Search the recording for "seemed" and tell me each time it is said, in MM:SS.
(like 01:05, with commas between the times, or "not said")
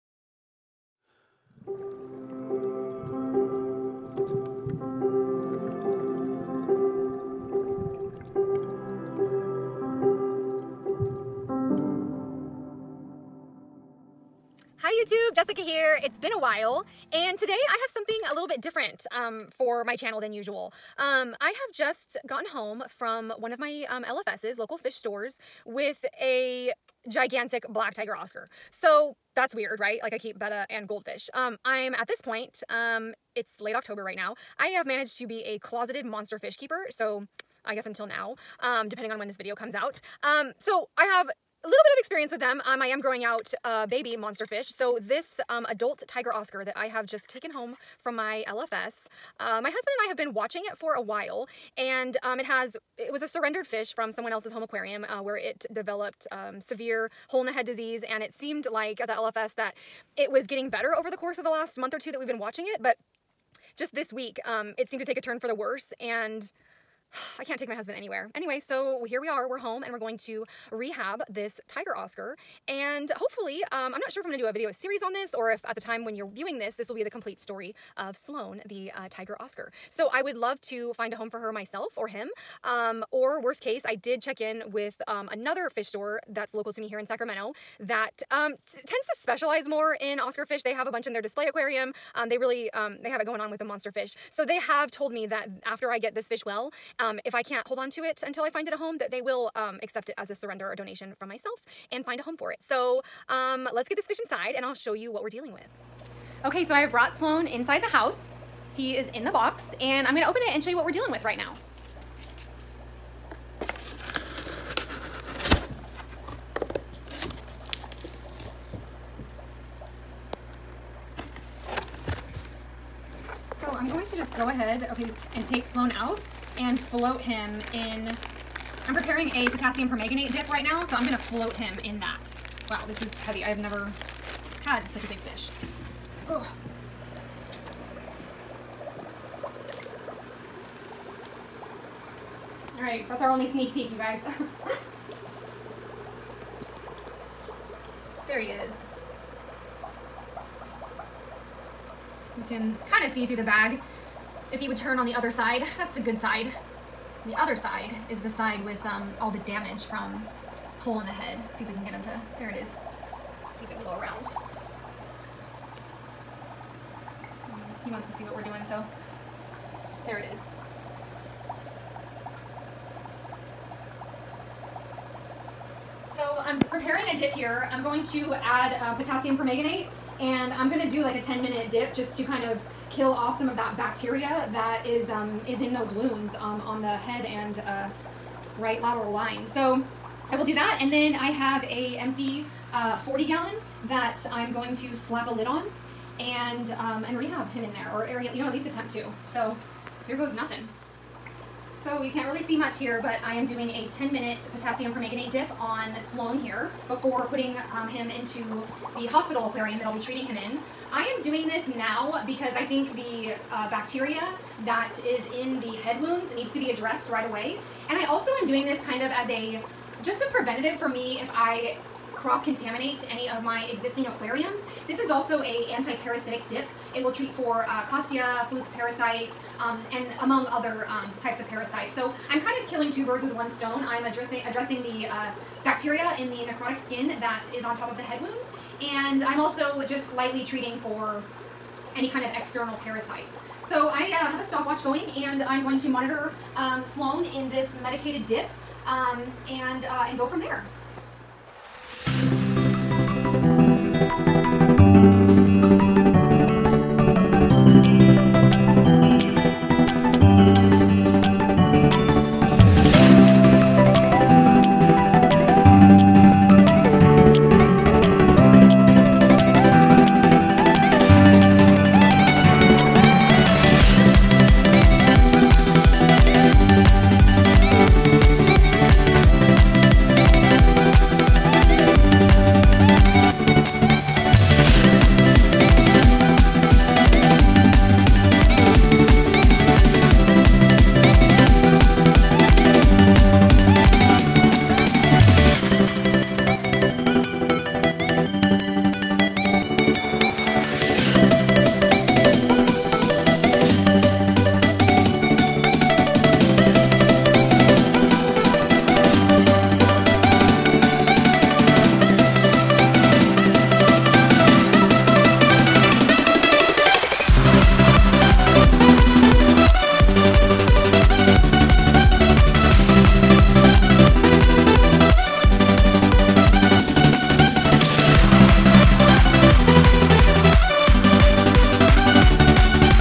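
00:58, 01:04.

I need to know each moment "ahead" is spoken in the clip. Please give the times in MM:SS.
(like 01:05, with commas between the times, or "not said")
02:04.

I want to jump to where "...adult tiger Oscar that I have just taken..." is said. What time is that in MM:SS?
00:45.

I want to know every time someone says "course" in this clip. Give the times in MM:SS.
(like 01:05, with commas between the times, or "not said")
01:01.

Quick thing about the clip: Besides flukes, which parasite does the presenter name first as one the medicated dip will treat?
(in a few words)
Costia.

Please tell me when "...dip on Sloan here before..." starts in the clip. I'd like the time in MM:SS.
03:25.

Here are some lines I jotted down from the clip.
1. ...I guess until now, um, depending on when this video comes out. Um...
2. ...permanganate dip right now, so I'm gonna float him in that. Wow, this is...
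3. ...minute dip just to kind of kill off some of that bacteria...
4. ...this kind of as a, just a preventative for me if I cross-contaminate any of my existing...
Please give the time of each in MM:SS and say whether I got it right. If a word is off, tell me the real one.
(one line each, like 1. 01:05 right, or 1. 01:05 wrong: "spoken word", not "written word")
1. 00:37 right
2. 02:09 right
3. 03:01 right
4. 03:38 right.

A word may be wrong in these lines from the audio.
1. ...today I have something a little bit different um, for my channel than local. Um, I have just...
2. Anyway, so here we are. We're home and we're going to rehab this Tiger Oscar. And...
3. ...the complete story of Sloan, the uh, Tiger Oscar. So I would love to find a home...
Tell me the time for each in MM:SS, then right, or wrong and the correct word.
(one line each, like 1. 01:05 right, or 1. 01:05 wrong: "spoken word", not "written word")
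1. 00:17 wrong: "usual", not "local"
2. 01:08 right
3. 01:17 right.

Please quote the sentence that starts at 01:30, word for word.
They have a bunch in their display aquarium.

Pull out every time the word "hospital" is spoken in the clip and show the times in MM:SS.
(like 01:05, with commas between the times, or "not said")
03:29.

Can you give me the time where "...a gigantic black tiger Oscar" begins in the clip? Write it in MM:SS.
00:26.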